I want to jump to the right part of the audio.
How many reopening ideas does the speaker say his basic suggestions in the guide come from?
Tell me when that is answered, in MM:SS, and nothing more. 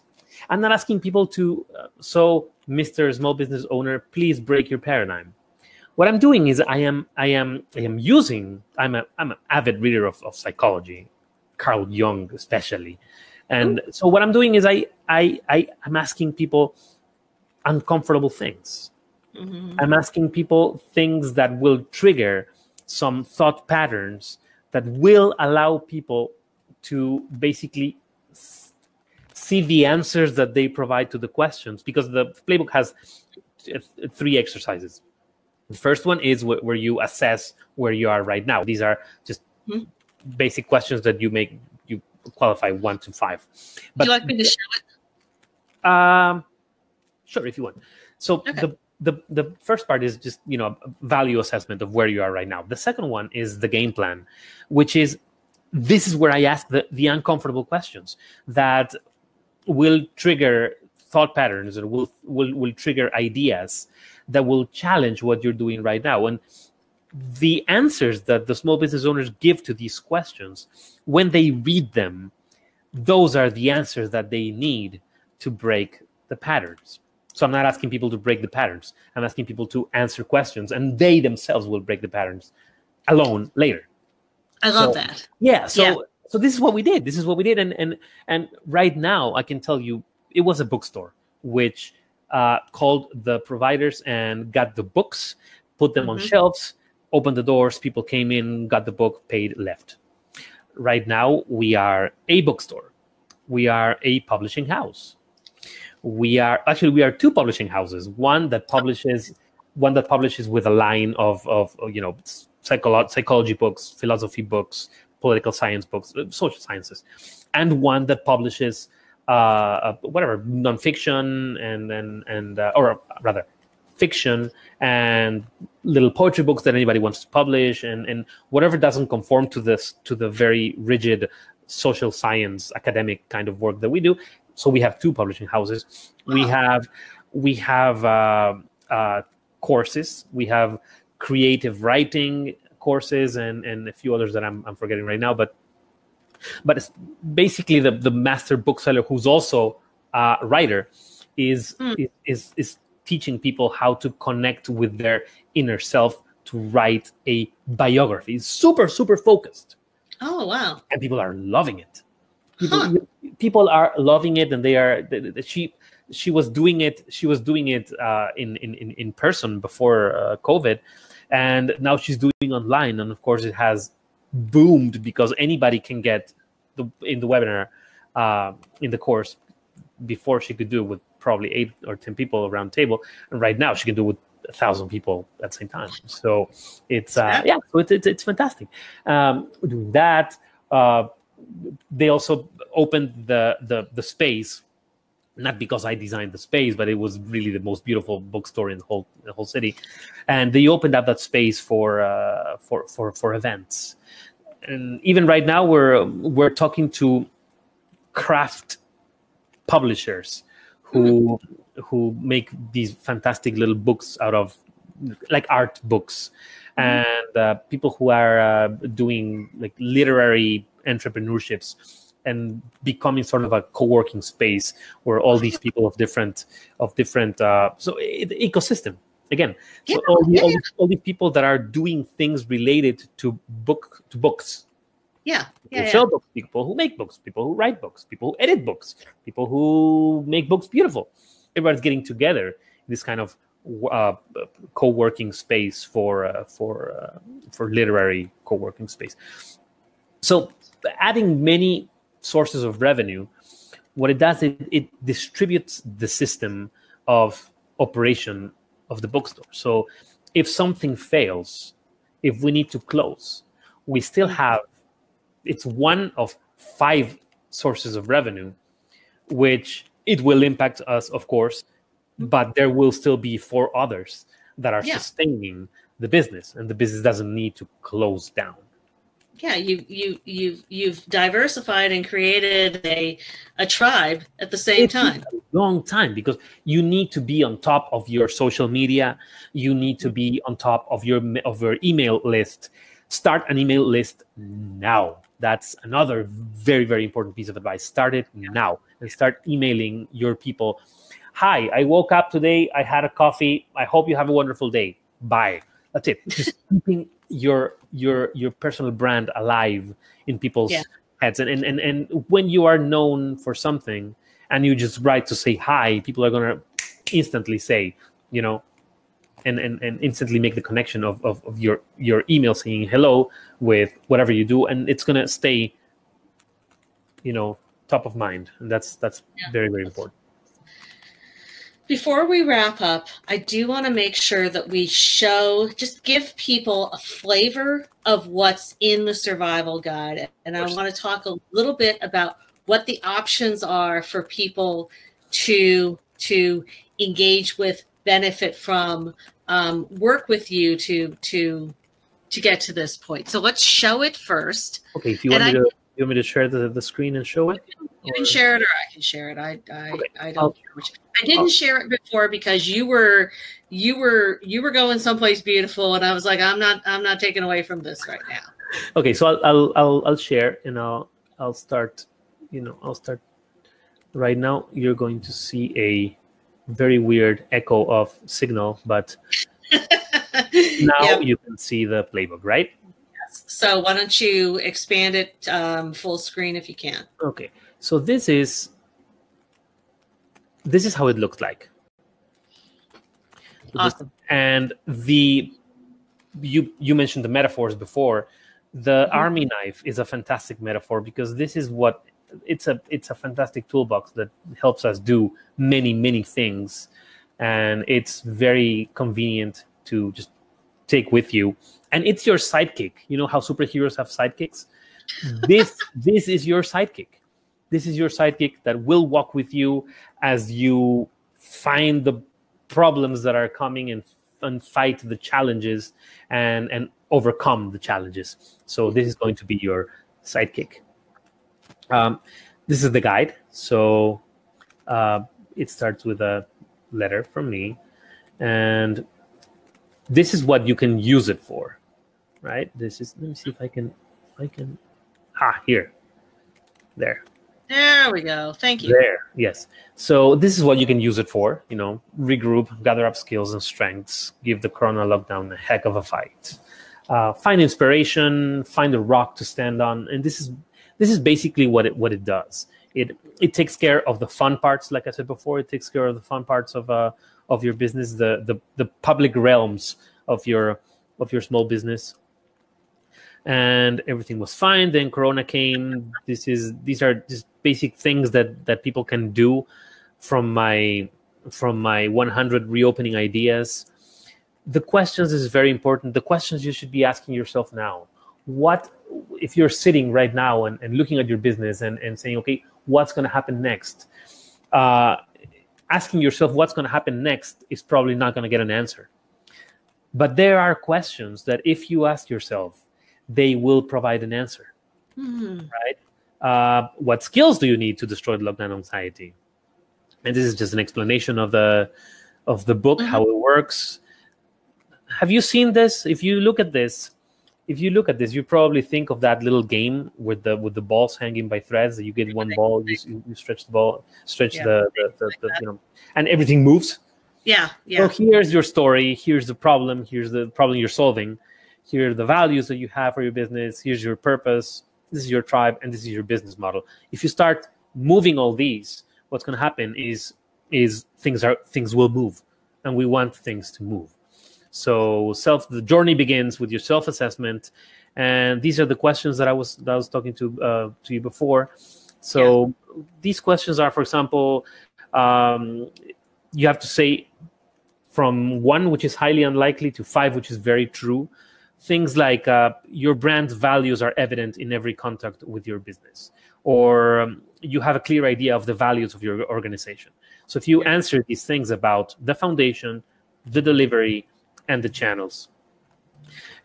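08:02.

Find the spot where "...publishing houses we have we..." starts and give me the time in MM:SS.
02:15.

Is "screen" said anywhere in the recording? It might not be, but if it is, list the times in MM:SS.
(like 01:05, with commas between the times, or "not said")
05:56, 06:26.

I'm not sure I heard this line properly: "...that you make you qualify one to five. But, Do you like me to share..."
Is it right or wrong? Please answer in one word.
right.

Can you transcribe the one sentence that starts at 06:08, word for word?
Okay, so I'll I'll I'll, I'll share, and I'll I'll start.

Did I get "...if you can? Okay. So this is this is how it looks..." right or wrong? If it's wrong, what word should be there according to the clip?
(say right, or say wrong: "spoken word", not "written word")
right.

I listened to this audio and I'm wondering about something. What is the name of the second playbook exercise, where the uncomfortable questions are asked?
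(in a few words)
The game plan.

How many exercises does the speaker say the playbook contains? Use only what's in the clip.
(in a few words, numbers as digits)
3.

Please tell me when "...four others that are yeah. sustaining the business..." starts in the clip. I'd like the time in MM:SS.
04:33.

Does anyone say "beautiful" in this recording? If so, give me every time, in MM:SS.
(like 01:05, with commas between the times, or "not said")
03:17, 04:00, 06:05.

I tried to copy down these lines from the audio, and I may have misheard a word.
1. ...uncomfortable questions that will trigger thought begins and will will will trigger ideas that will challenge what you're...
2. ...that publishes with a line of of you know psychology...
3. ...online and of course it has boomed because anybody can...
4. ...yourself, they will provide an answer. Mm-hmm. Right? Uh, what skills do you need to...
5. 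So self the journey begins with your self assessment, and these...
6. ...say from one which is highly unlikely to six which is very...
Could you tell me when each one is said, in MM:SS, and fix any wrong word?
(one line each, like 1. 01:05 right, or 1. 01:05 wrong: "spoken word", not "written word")
1. 00:57 wrong: "patterns", not "begins"
2. 01:49 right
3. 02:52 right
4. 08:22 right
5. 09:04 right
6. 09:16 wrong: "five", not "six".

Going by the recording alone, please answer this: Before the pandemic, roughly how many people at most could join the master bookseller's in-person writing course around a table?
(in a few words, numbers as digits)
10.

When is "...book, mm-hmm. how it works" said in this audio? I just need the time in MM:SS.
08:32.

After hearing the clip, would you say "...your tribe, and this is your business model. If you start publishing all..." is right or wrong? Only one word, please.
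wrong.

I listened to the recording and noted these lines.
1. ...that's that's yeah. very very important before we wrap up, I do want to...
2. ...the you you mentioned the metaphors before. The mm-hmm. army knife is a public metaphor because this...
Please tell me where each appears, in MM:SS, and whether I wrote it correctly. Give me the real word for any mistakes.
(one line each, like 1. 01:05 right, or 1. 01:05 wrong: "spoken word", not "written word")
1. 05:28 right
2. 06:34 wrong: "fantastic", not "public".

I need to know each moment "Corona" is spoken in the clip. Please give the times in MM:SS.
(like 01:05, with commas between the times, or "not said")
07:34, 07:55.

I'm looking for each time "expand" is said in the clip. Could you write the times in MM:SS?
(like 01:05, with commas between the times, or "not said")
06:24.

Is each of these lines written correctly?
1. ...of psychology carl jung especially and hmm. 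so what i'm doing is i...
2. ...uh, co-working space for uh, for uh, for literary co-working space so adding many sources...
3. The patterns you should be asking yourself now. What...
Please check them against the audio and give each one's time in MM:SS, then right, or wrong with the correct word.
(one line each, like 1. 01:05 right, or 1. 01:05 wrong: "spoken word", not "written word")
1. 00:10 right
2. 04:03 right
3. 08:06 wrong: "questions", not "patterns".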